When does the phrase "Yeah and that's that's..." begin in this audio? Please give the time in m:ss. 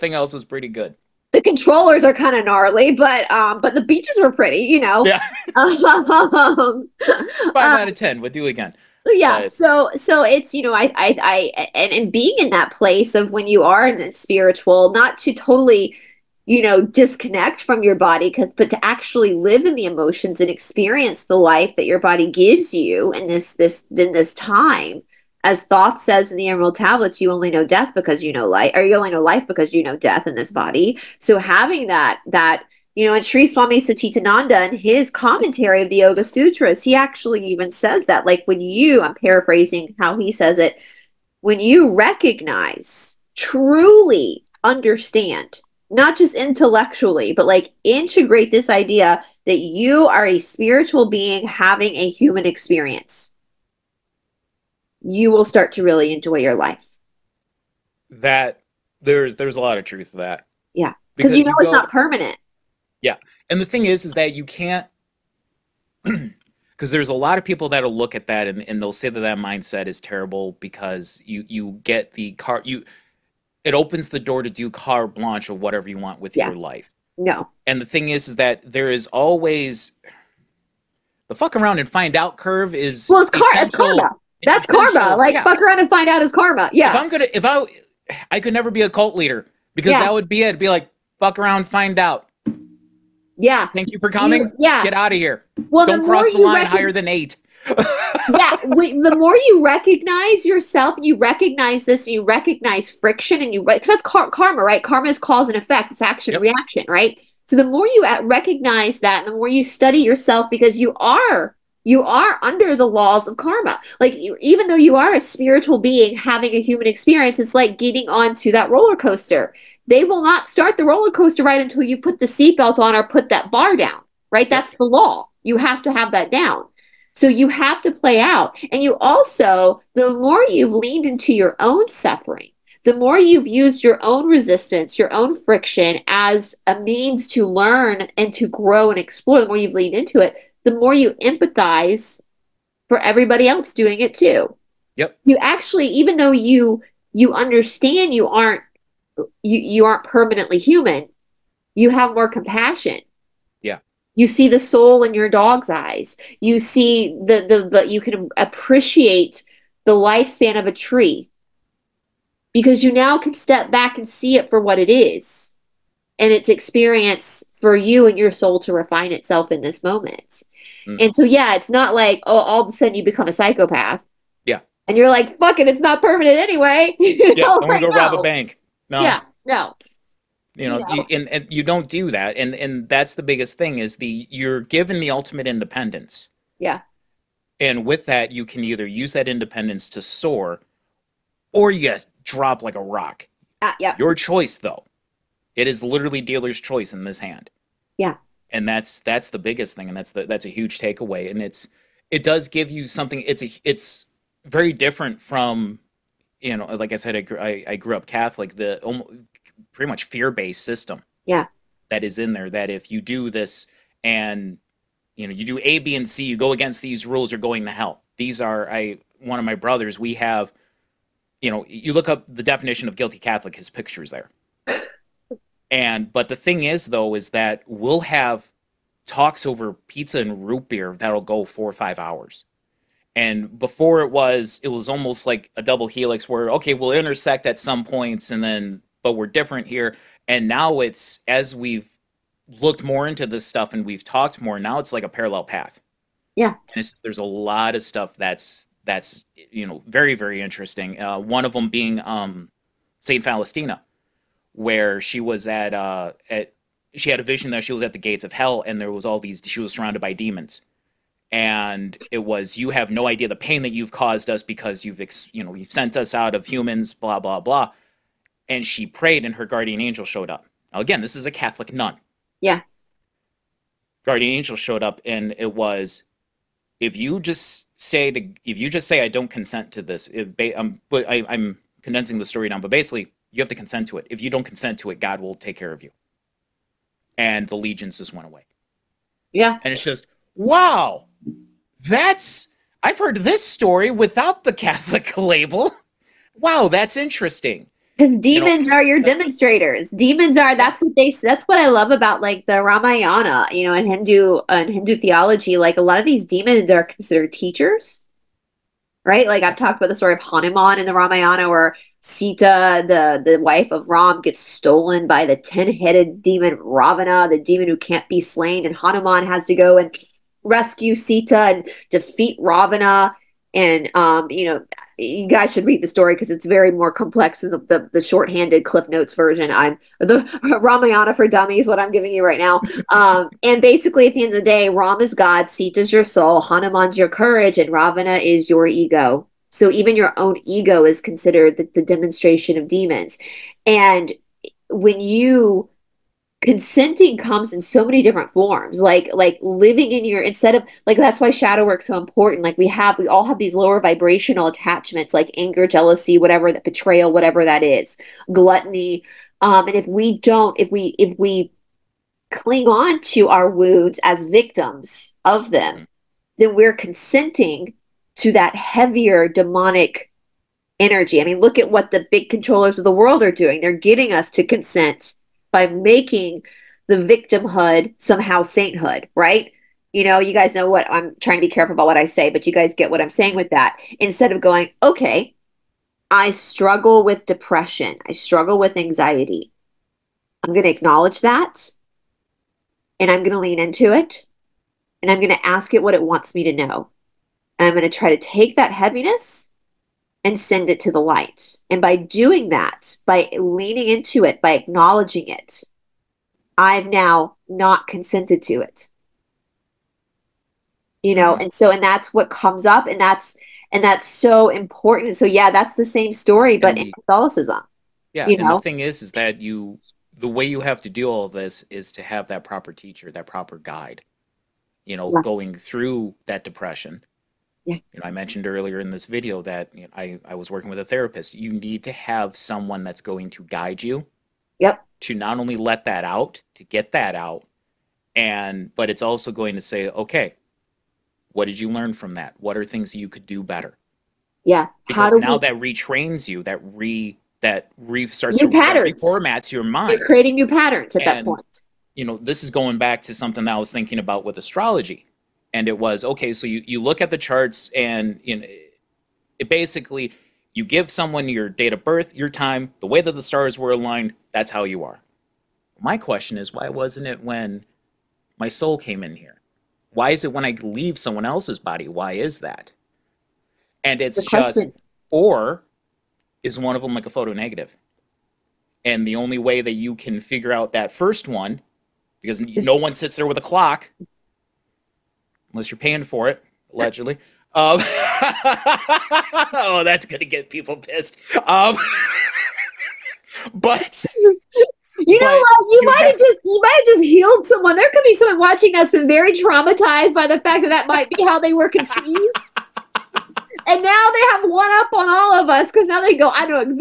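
3:17.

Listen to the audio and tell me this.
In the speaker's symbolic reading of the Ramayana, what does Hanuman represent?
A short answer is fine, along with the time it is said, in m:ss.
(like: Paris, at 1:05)
Courage, at 5:37.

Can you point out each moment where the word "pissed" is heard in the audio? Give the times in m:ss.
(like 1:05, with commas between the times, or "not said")
8:10.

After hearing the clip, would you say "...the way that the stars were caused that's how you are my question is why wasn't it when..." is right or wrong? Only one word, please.
wrong.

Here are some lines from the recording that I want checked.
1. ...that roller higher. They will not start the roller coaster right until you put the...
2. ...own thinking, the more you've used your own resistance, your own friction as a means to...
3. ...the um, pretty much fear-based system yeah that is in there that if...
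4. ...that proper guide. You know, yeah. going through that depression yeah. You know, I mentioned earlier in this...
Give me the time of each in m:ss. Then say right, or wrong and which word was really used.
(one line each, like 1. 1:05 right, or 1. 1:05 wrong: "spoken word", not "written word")
1. 1:58 wrong: "coaster", not "higher"
2. 2:11 wrong: "suffering", not "thinking"
3. 3:28 right
4. 7:03 right.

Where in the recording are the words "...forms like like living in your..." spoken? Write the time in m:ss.
5:48.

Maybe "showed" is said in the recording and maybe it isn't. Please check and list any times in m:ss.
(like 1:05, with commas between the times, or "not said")
4:30, 4:34.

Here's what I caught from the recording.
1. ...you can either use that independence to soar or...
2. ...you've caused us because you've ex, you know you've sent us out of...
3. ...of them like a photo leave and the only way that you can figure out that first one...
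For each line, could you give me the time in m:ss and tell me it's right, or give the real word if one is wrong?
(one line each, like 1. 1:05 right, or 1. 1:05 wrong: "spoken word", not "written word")
1. 3:08 right
2. 4:23 right
3. 7:56 wrong: "negative", not "leave".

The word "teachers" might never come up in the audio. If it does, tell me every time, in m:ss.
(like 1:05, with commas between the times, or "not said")
5:07, 7:02.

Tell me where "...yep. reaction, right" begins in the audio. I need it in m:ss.
1:46.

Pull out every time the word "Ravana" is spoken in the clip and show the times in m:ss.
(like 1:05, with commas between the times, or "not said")
5:16, 5:22, 5:37.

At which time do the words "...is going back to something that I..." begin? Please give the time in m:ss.
7:32.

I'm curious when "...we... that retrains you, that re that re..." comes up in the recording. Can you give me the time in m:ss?
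7:25.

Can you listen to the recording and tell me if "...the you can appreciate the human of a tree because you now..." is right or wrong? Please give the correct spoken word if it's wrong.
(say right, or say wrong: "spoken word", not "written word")
wrong: "lifespan", not "human".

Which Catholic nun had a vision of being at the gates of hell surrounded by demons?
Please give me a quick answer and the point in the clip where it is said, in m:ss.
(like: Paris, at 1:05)
Saint Faustina, at 4:12.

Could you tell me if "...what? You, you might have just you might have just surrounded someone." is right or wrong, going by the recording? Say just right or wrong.
wrong.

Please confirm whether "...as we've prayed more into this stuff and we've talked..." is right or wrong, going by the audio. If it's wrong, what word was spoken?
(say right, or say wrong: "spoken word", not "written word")
wrong: "looked", not "prayed".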